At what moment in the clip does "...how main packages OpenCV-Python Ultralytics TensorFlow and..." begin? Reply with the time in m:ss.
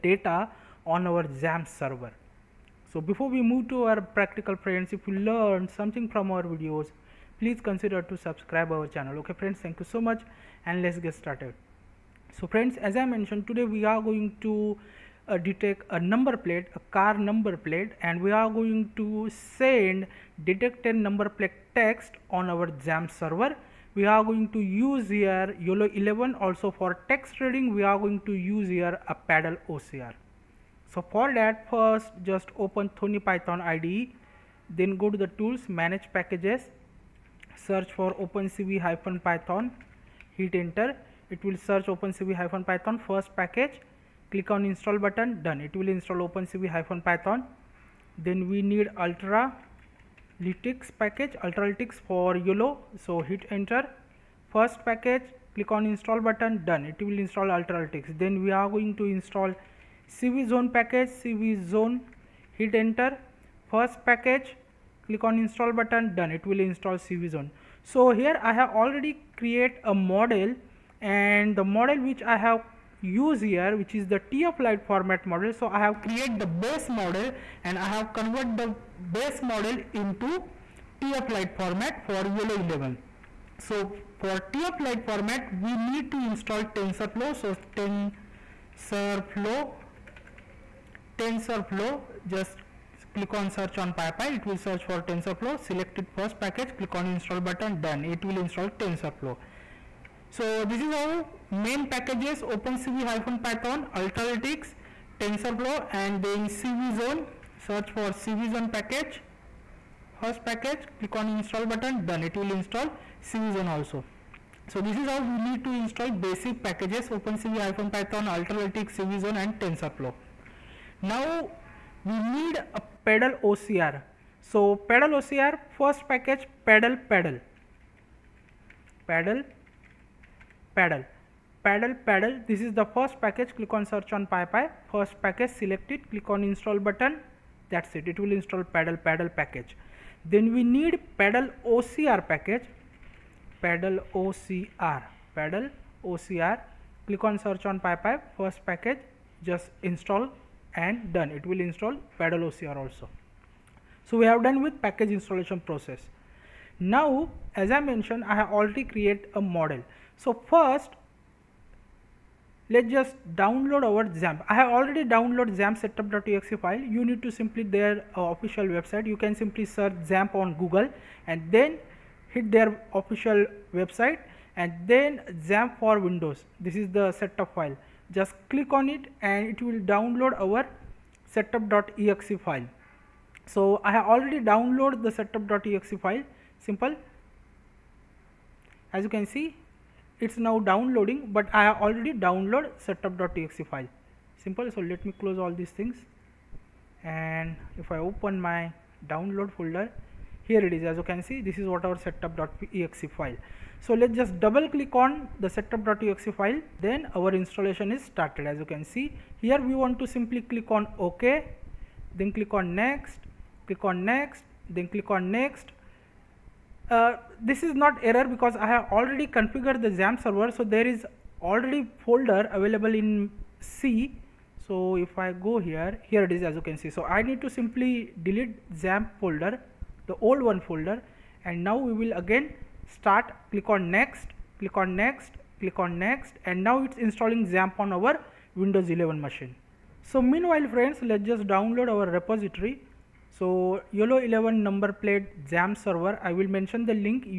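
1:40.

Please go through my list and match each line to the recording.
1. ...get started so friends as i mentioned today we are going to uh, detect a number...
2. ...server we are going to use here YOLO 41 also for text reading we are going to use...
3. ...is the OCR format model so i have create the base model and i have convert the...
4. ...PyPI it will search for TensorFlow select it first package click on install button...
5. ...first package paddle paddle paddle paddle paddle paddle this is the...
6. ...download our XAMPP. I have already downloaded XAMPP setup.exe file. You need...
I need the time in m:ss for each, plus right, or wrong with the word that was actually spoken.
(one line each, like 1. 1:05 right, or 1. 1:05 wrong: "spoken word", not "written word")
1. 0:11 right
2. 0:23 wrong: "11", not "41"
3. 1:13 wrong: "TFLite", not "OCR"
4. 1:33 right
5. 2:05 right
6. 2:43 right.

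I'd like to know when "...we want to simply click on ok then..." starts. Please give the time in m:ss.
3:29.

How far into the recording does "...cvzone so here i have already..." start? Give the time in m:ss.
1:07.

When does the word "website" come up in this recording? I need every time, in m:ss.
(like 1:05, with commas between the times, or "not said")
2:48, 2:53.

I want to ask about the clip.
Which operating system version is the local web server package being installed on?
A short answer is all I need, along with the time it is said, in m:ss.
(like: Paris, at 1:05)
Windows 11, at 3:58.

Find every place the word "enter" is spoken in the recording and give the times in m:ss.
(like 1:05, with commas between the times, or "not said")
0:40, 0:53, 1:02.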